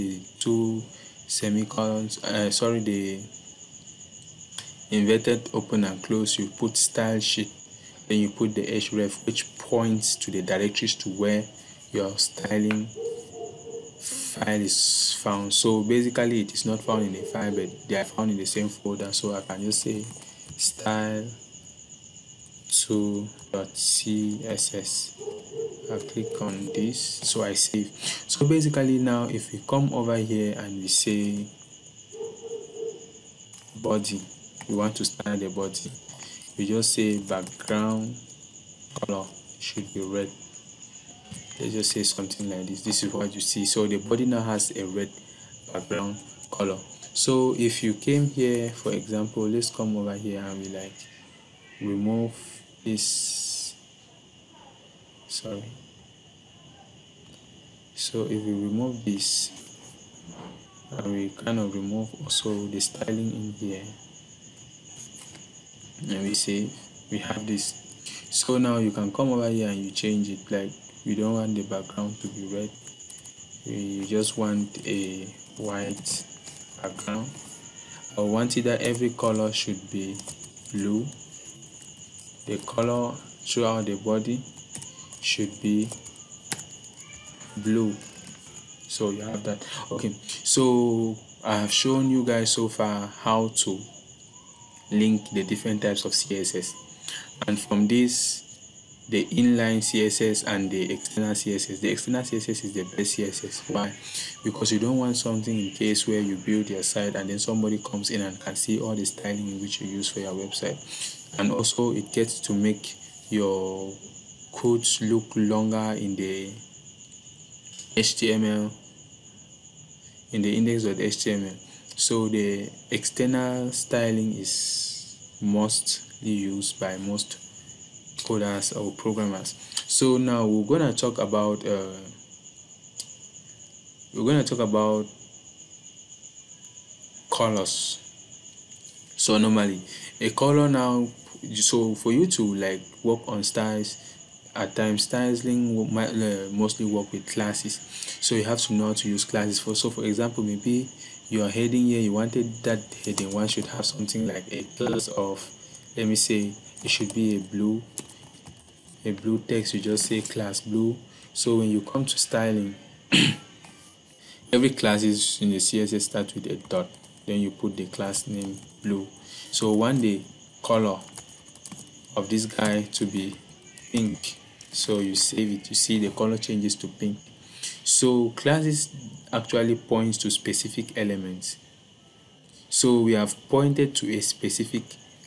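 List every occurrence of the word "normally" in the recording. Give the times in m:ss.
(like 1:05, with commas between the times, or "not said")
2:19.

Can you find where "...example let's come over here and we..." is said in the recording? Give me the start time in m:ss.
0:48.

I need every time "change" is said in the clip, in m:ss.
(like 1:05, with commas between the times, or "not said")
1:09, 2:56.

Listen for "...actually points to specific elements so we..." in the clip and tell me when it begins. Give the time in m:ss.
2:59.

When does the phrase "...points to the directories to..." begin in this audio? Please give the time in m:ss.
0:09.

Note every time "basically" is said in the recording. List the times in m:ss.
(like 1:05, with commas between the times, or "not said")
0:15, 0:28.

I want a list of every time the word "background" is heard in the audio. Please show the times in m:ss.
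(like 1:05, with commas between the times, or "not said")
0:37, 0:45, 1:11, 1:16.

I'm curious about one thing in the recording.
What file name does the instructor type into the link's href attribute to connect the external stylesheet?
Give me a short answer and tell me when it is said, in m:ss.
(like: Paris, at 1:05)
style2.css, at 0:20.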